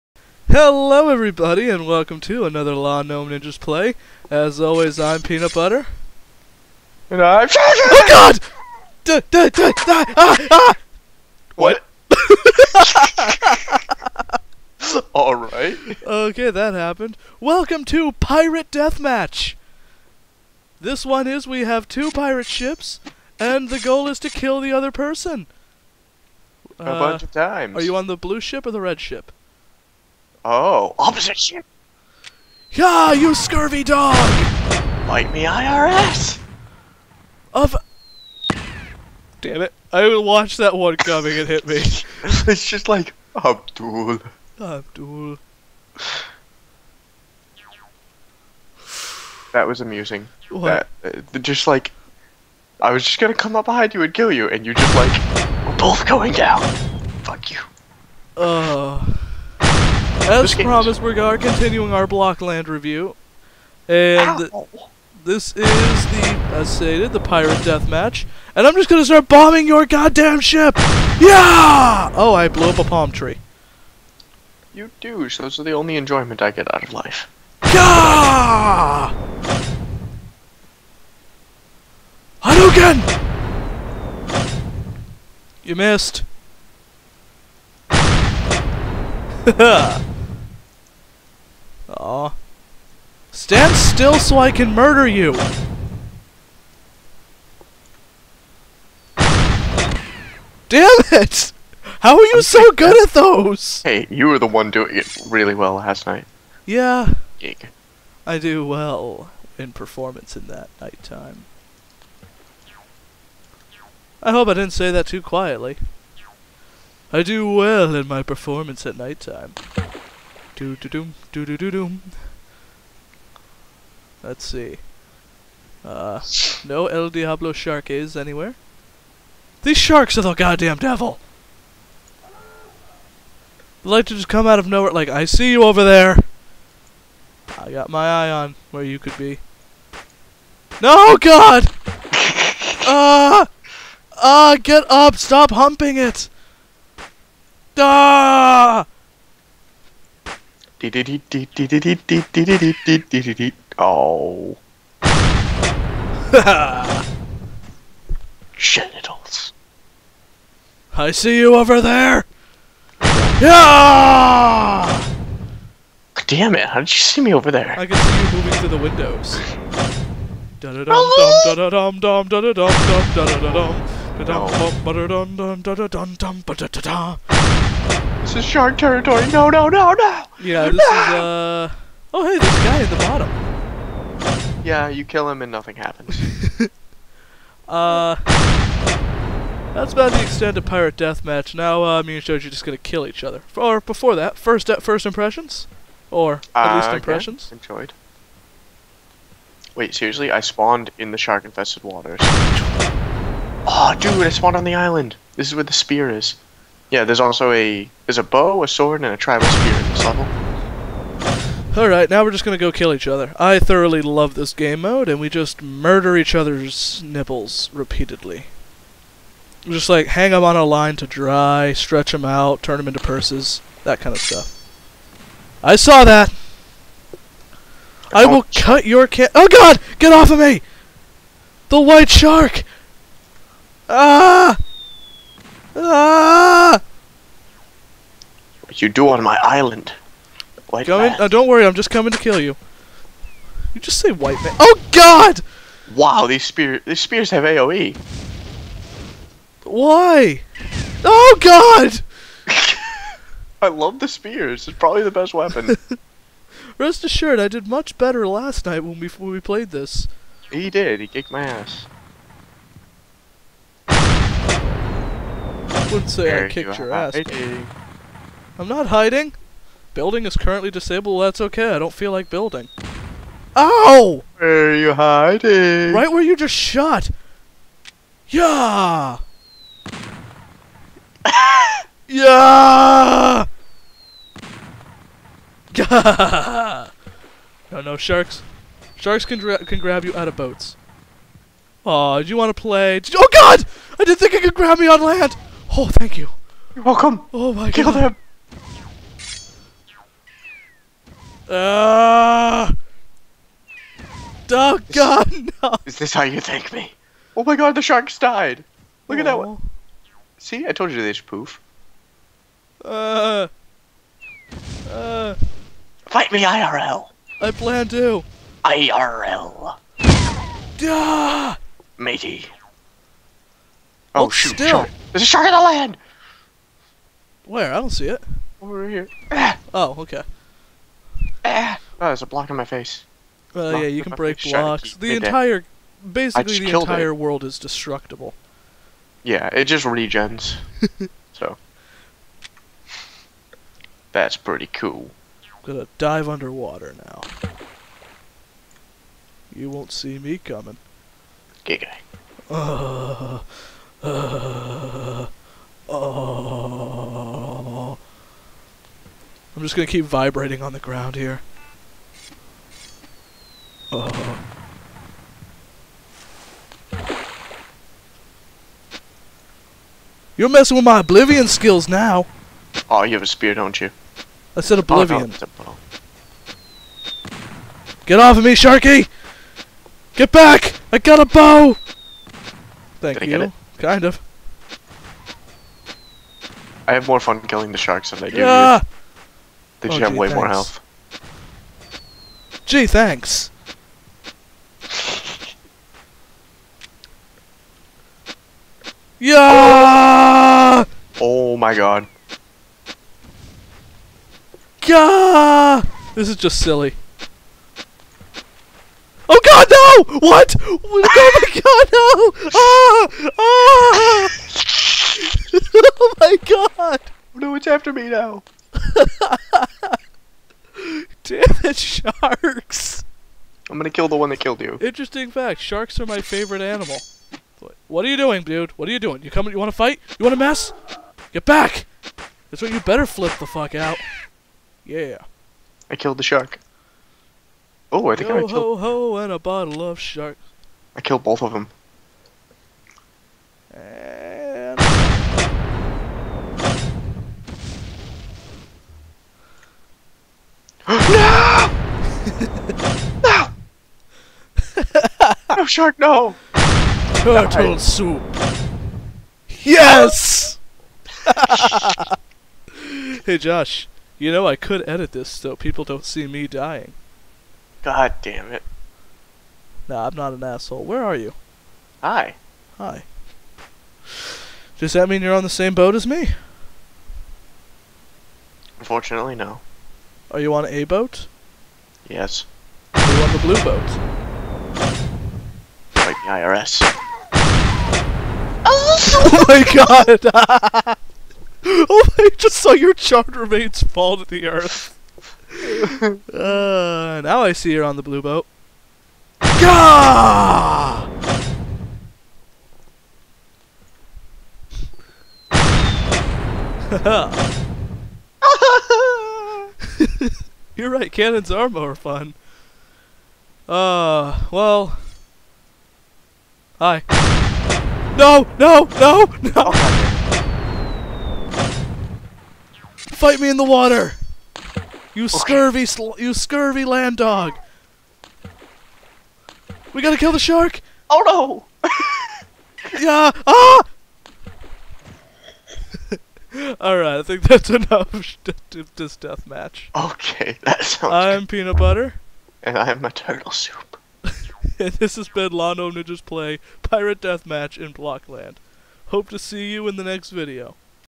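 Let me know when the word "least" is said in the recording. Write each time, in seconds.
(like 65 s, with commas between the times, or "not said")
196 s.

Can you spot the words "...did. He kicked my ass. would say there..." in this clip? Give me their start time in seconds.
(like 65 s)
260 s.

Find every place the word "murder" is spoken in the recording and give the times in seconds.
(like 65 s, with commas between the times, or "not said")
94 s, 215 s.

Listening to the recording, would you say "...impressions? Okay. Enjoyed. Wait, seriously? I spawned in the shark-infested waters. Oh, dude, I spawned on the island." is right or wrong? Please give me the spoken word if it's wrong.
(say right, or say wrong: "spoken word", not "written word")
right.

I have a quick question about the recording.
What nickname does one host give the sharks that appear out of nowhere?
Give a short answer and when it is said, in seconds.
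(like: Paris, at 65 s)
El Diablo shark, at 126 s.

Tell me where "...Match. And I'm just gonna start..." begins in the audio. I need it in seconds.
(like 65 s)
67 s.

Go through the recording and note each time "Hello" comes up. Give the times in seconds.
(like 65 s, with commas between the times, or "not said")
0 s.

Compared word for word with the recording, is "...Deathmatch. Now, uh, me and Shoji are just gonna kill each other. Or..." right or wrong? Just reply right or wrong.
right.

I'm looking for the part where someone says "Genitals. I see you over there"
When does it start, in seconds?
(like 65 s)
158 s.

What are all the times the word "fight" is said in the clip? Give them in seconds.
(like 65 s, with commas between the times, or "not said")
316 s, 429 s, 522 s.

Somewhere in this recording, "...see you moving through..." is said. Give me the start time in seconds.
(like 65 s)
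167 s.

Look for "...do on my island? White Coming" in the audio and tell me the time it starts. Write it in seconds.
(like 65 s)
238 s.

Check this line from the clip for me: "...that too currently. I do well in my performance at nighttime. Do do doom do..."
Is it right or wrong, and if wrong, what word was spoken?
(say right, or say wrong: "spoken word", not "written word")
wrong: "quietly", not "currently".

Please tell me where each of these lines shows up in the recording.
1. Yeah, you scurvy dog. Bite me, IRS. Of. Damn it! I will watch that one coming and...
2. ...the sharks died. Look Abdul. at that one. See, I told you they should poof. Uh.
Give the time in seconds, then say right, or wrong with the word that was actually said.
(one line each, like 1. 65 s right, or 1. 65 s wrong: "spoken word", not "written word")
1. 32 s right
2. 307 s wrong: "Aww", not "Abdul".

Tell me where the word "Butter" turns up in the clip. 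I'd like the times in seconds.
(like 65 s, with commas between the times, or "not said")
5 s, 541 s.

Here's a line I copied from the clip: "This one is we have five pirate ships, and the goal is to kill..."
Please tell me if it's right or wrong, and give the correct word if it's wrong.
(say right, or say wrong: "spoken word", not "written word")
wrong: "two", not "five".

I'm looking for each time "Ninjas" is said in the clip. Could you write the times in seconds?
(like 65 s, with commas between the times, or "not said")
3 s, 545 s.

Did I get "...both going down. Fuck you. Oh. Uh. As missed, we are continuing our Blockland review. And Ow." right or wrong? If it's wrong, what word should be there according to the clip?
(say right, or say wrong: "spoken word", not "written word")
wrong: "promised", not "missed".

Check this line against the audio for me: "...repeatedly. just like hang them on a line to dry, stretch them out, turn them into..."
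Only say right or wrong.
right.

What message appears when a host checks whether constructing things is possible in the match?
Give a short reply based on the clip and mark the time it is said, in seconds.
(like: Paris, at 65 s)
Building is currently disabled, at 269 s.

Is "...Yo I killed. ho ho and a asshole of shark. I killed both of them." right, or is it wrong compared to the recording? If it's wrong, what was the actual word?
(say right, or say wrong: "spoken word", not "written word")
wrong: "bottle", not "asshole".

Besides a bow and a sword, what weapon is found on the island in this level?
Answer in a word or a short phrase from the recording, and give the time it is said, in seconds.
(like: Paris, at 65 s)
Tribal spear, at 209 s.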